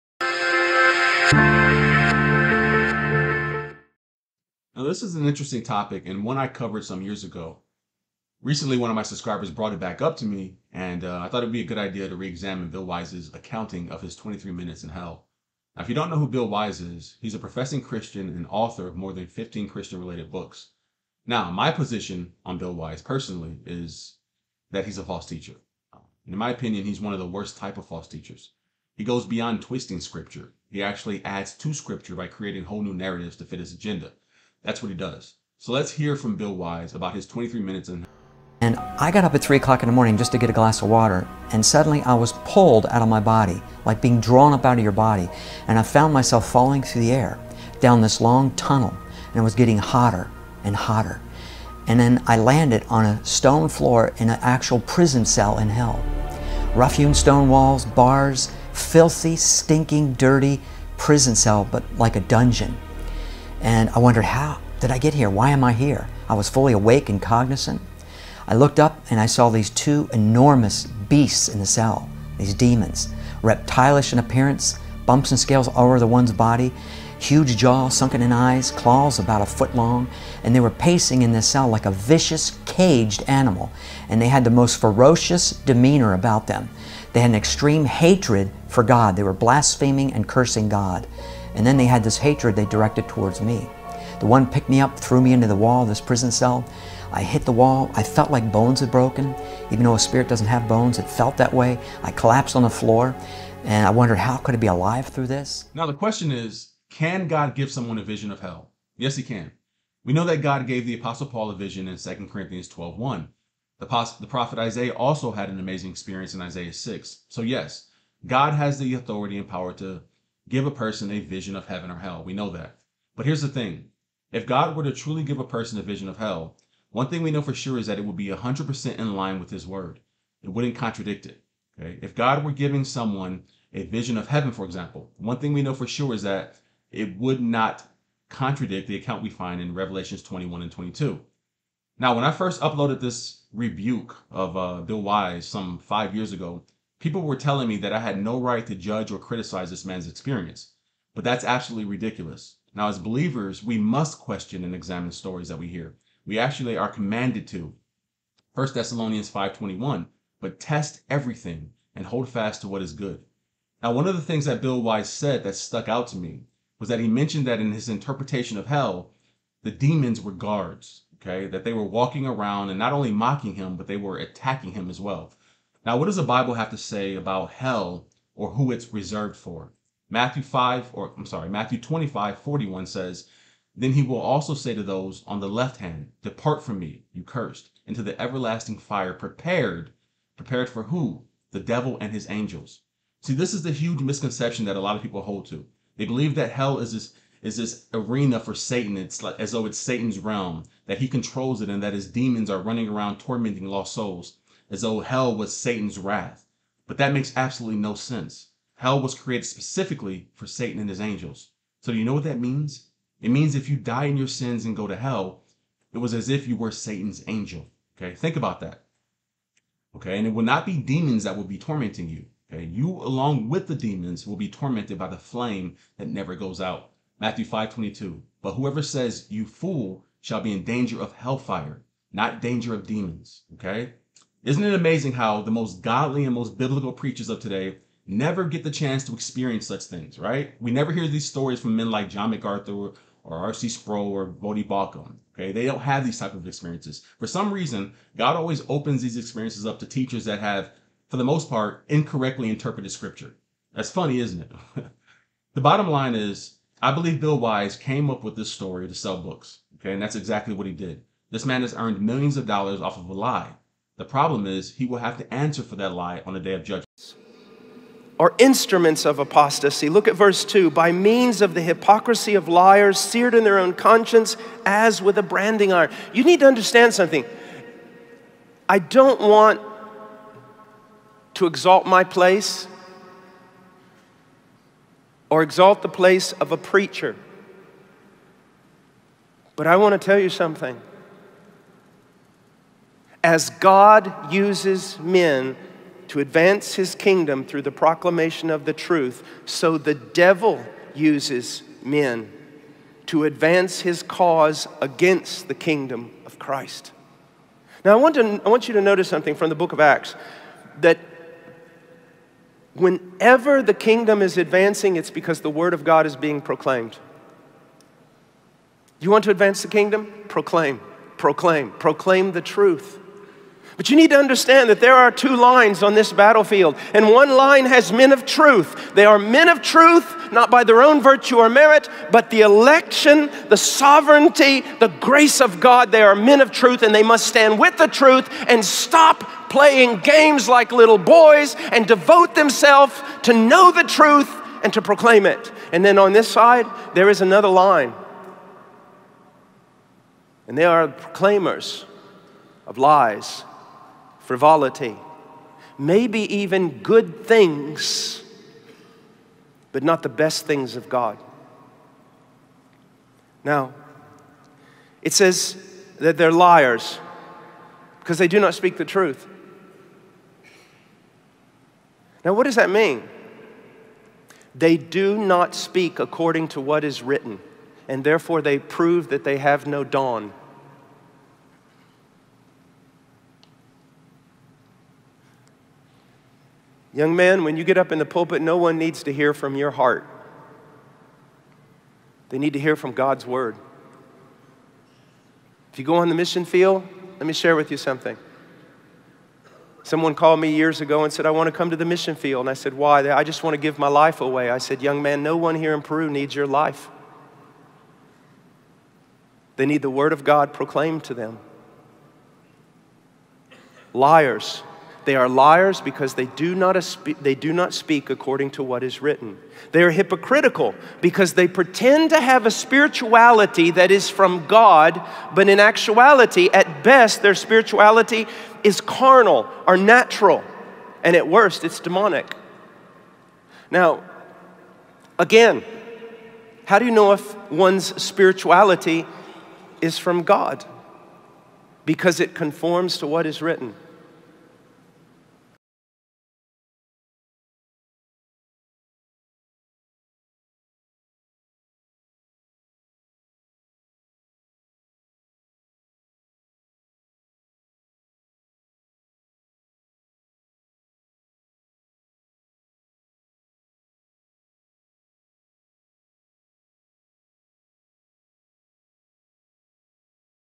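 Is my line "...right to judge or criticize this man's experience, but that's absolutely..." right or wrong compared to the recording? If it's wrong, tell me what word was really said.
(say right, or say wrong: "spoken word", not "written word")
right.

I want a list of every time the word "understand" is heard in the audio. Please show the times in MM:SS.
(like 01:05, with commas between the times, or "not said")
04:36, 05:24.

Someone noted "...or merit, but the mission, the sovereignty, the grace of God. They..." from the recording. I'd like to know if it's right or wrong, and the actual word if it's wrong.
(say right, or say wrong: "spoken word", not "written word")
wrong: "election", not "mission".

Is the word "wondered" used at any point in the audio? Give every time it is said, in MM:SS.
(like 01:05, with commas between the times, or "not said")
01:03, 01:43.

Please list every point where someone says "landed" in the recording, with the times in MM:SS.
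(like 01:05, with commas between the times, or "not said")
00:52.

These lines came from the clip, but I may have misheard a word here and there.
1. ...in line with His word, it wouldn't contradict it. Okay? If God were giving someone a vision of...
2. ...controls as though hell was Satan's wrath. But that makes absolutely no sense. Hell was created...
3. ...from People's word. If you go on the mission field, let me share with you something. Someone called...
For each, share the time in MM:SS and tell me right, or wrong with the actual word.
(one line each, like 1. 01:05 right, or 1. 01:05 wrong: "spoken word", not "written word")
1. 02:08 right
2. 03:23 wrong: "souls", not "controls"
3. 06:32 wrong: "God", not "People".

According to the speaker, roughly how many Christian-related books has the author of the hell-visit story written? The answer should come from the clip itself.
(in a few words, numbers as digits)
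More than 15.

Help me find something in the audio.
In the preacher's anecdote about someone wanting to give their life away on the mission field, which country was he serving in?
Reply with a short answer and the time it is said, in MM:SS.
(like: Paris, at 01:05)
Peru, at 06:45.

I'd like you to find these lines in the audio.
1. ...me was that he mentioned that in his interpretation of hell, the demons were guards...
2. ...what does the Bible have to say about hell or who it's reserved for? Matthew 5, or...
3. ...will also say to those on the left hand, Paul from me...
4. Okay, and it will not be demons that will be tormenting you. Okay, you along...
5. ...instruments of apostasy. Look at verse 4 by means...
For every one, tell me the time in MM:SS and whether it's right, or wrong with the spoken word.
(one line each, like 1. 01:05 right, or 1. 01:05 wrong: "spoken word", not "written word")
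1. 02:46 right
2. 02:55 right
3. 03:04 wrong: "Depart", not "Paul"
4. 03:39 right
5. 04:28 wrong: "2", not "4".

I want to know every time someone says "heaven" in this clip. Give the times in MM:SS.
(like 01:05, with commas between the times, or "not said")
02:01, 02:14.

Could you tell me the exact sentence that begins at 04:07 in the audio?
For some reason, God always opens these experiences up to teachers that have, for the most part, incorrectly interpreted Scripture.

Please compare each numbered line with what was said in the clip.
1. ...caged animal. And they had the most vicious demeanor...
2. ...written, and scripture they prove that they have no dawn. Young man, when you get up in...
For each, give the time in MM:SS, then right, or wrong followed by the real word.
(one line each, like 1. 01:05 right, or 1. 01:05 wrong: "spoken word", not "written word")
1. 01:22 wrong: "ferocious", not "vicious"
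2. 06:17 wrong: "therefore", not "scripture".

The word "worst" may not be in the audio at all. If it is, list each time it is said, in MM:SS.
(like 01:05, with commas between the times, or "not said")
00:27, 07:11.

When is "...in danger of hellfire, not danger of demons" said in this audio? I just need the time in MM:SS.
03:50.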